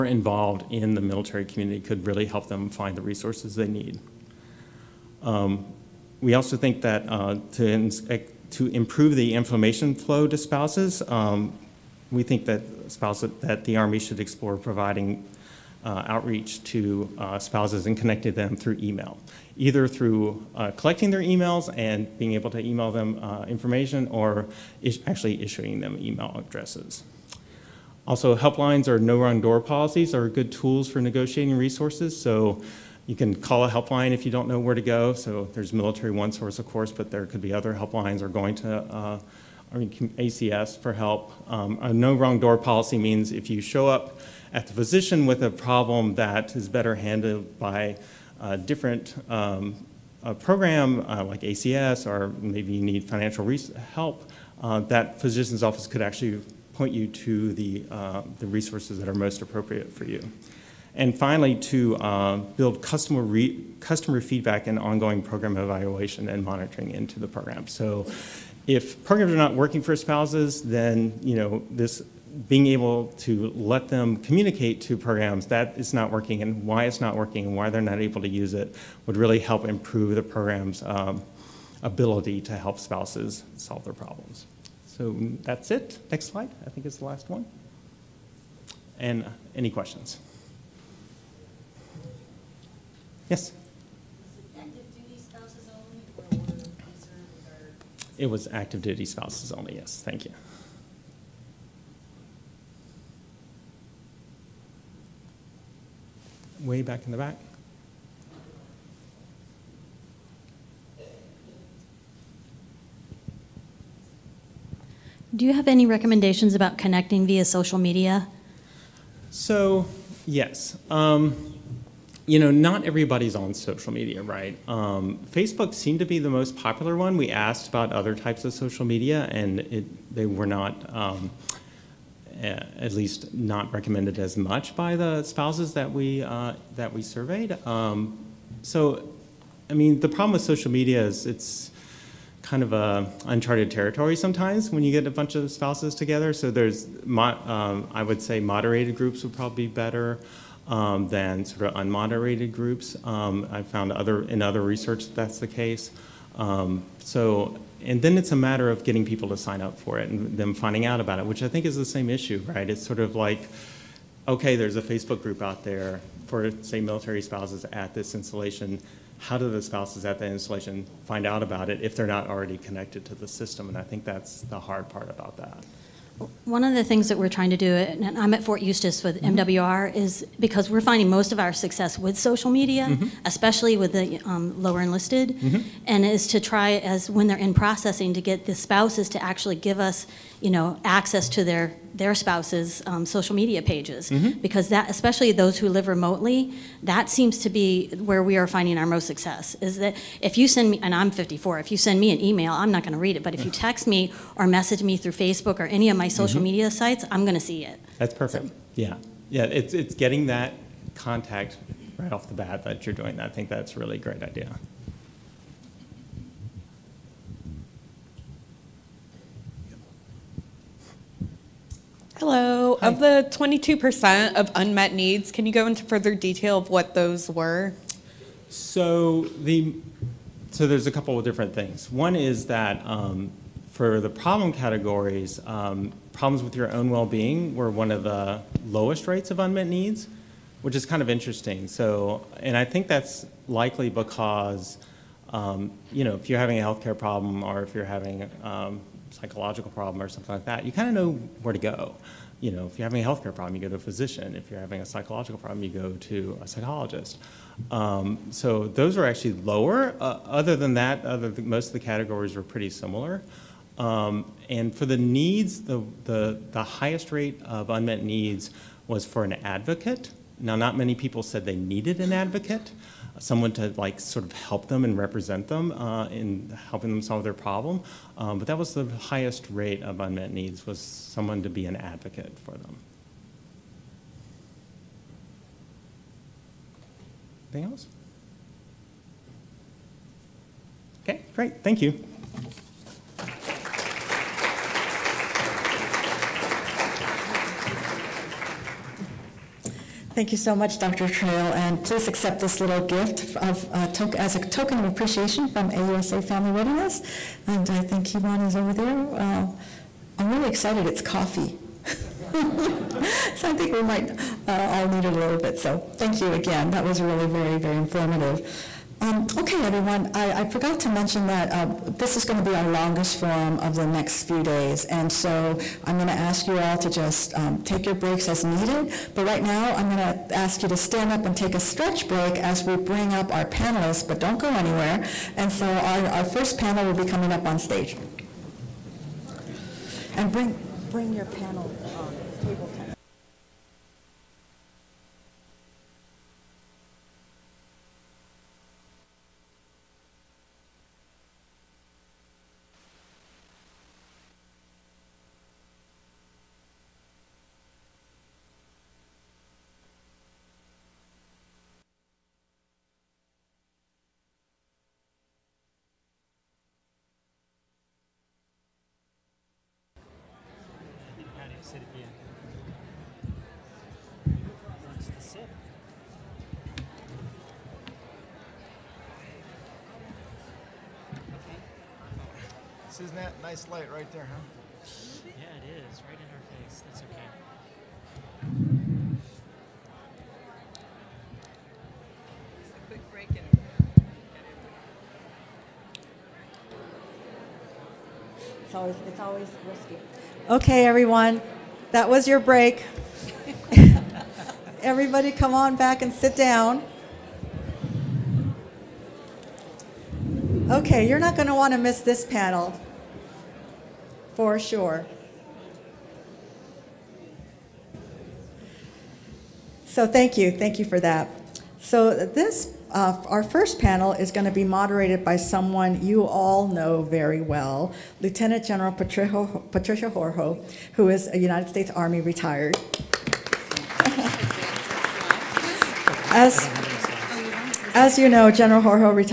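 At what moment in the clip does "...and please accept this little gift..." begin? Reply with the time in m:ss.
5:01.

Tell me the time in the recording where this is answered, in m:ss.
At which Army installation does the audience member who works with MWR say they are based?
2:58.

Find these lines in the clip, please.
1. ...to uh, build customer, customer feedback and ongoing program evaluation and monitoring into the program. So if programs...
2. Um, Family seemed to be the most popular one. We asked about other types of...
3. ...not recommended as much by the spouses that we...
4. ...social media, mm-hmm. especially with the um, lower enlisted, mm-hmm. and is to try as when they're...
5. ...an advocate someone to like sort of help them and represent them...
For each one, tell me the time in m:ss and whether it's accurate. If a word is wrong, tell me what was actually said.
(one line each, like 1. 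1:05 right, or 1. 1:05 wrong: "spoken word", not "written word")
1. 1:01 right
2. 2:04 wrong: "Facebook", not "Family"
3. 2:13 right
4. 3:02 right
5. 4:32 right.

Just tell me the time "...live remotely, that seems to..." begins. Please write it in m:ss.
3:15.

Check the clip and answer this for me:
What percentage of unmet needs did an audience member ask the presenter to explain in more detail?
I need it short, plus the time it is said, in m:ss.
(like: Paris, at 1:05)
22%, at 3:43.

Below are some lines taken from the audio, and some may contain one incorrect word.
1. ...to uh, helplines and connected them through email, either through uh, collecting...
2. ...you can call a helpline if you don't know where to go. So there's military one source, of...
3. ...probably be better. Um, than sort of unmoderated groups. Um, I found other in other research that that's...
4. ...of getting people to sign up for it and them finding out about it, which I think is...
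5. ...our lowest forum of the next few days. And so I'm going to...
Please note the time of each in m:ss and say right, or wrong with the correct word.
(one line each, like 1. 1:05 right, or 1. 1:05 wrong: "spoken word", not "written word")
1. 0:16 wrong: "spouses", not "helplines"
2. 0:33 right
3. 2:29 right
4. 2:38 right
5. 5:22 wrong: "longest", not "lowest".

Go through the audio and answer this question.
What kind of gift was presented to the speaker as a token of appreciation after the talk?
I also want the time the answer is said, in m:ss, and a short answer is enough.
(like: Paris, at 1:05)
Coffee, at 5:11.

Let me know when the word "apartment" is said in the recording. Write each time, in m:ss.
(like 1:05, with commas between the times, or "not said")
not said.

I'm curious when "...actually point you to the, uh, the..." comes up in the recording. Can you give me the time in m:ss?
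0:56.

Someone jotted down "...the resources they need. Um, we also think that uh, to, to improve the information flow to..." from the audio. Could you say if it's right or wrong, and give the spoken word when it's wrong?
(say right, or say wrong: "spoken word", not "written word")
right.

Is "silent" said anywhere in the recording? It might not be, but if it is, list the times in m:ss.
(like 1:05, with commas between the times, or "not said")
not said.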